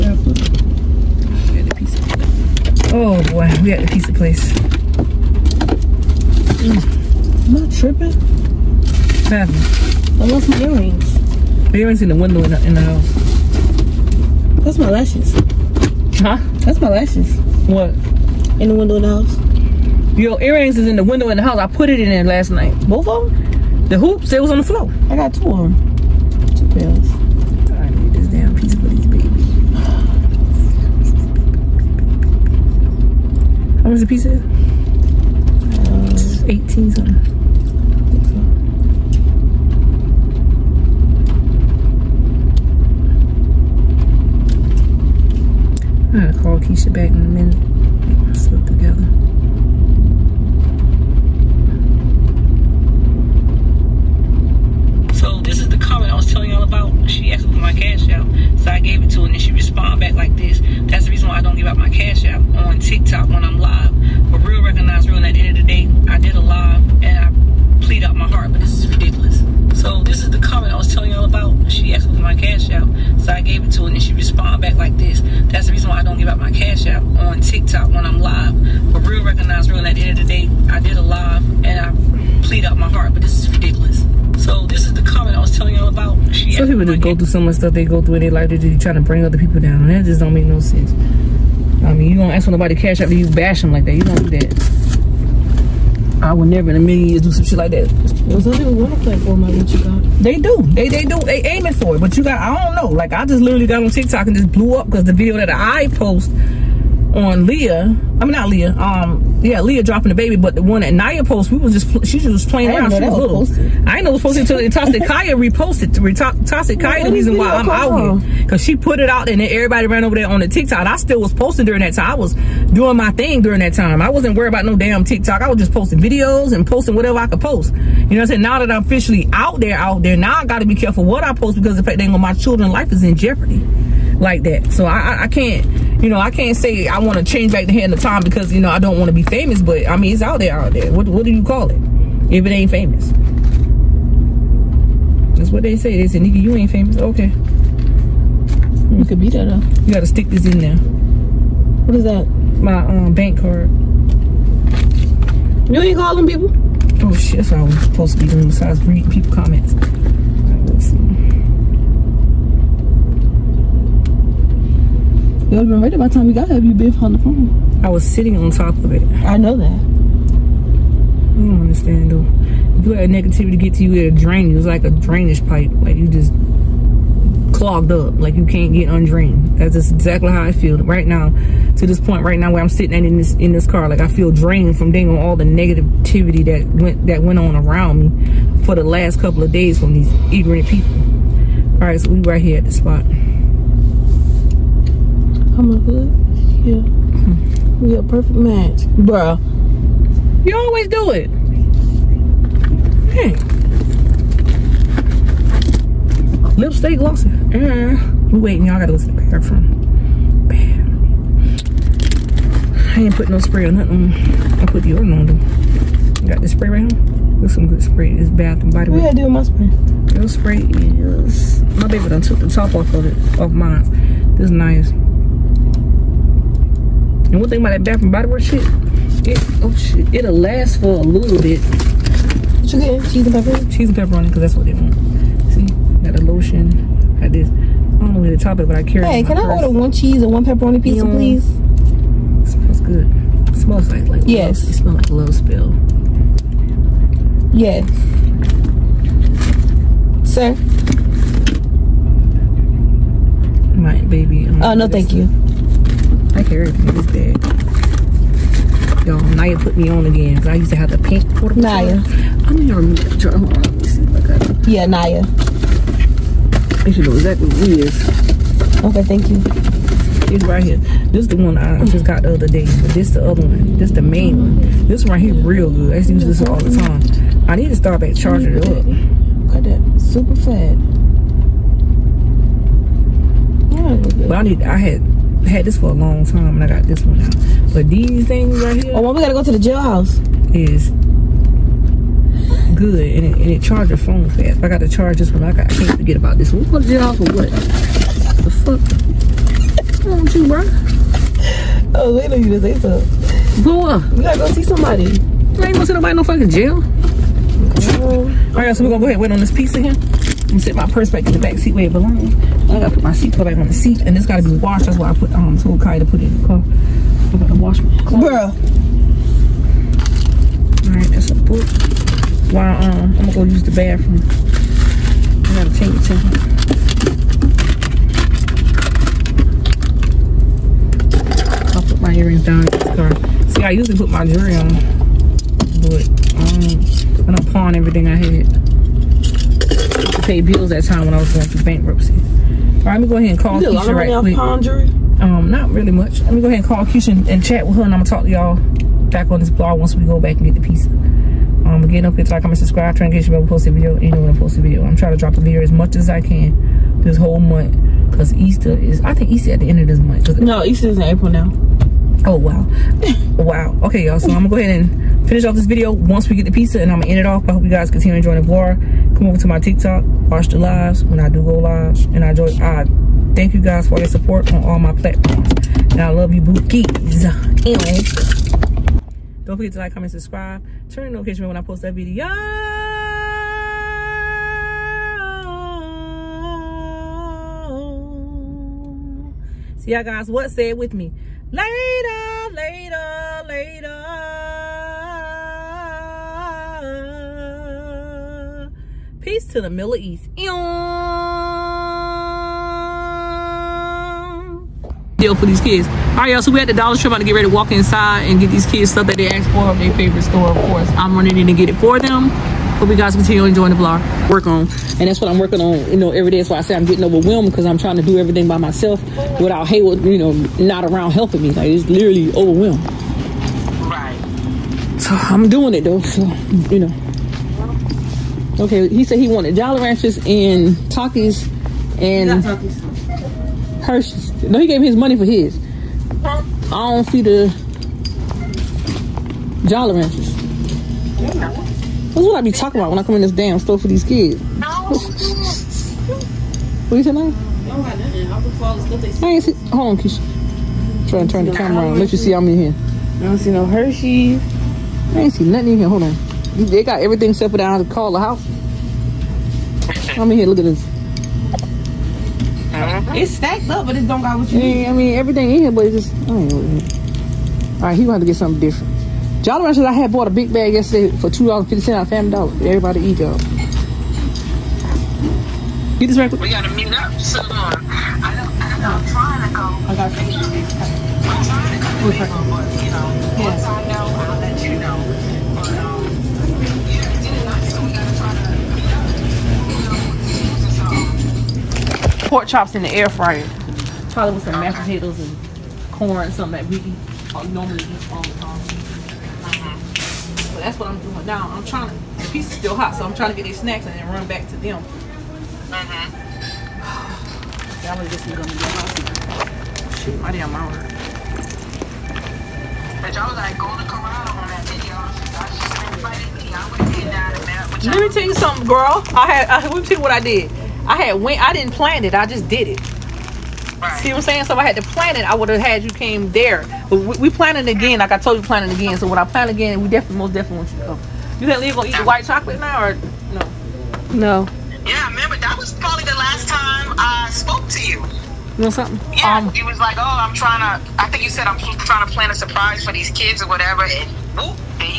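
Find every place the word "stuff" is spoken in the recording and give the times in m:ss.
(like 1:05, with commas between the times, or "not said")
1:27, 6:48.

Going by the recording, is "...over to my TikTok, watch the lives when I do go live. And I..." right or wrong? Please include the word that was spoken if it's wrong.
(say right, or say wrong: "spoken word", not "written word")
right.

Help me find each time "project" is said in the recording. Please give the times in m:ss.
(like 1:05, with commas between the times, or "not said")
not said.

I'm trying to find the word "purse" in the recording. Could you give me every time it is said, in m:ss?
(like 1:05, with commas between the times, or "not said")
3:59, 5:10.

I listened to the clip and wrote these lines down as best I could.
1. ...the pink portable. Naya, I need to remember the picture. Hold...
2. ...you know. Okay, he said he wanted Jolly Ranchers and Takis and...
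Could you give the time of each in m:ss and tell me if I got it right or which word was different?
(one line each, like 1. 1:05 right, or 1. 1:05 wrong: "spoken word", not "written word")
1. 4:20 right
2. 7:06 right.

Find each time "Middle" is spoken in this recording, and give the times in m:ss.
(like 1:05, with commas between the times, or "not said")
6:39.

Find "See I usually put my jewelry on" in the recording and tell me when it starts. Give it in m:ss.
5:33.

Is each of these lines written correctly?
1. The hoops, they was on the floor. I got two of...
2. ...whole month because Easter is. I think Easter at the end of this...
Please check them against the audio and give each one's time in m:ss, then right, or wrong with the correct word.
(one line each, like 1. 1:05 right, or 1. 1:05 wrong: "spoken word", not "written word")
1. 0:23 right
2. 5:57 right.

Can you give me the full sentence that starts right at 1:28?
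They're just trying to bring other people down.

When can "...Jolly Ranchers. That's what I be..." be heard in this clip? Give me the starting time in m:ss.
7:19.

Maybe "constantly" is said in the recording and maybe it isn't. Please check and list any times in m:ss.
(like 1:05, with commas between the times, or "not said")
not said.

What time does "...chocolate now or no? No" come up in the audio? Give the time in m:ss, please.
8:52.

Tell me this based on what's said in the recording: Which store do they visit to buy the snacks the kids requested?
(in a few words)
Dollar Tree.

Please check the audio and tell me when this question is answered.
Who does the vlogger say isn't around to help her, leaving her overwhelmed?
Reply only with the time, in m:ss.
6:59.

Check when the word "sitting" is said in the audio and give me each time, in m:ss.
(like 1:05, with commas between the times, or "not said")
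2:48, 3:02, 5:10.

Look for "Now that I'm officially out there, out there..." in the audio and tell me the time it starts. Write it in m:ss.
2:08.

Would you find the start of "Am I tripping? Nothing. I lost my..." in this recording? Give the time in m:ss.
0:07.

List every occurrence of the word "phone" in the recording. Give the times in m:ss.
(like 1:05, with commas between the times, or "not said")
2:47, 4:53.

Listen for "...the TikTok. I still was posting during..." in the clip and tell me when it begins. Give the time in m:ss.
2:00.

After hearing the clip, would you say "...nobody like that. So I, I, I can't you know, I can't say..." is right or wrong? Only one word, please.
wrong.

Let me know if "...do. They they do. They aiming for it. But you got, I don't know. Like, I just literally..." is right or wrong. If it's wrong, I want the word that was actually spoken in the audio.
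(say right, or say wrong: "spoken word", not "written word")
right.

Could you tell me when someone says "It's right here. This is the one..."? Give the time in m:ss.
4:30.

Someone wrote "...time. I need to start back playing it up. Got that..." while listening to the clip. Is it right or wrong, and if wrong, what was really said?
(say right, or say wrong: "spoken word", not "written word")
wrong: "charging", not "playing".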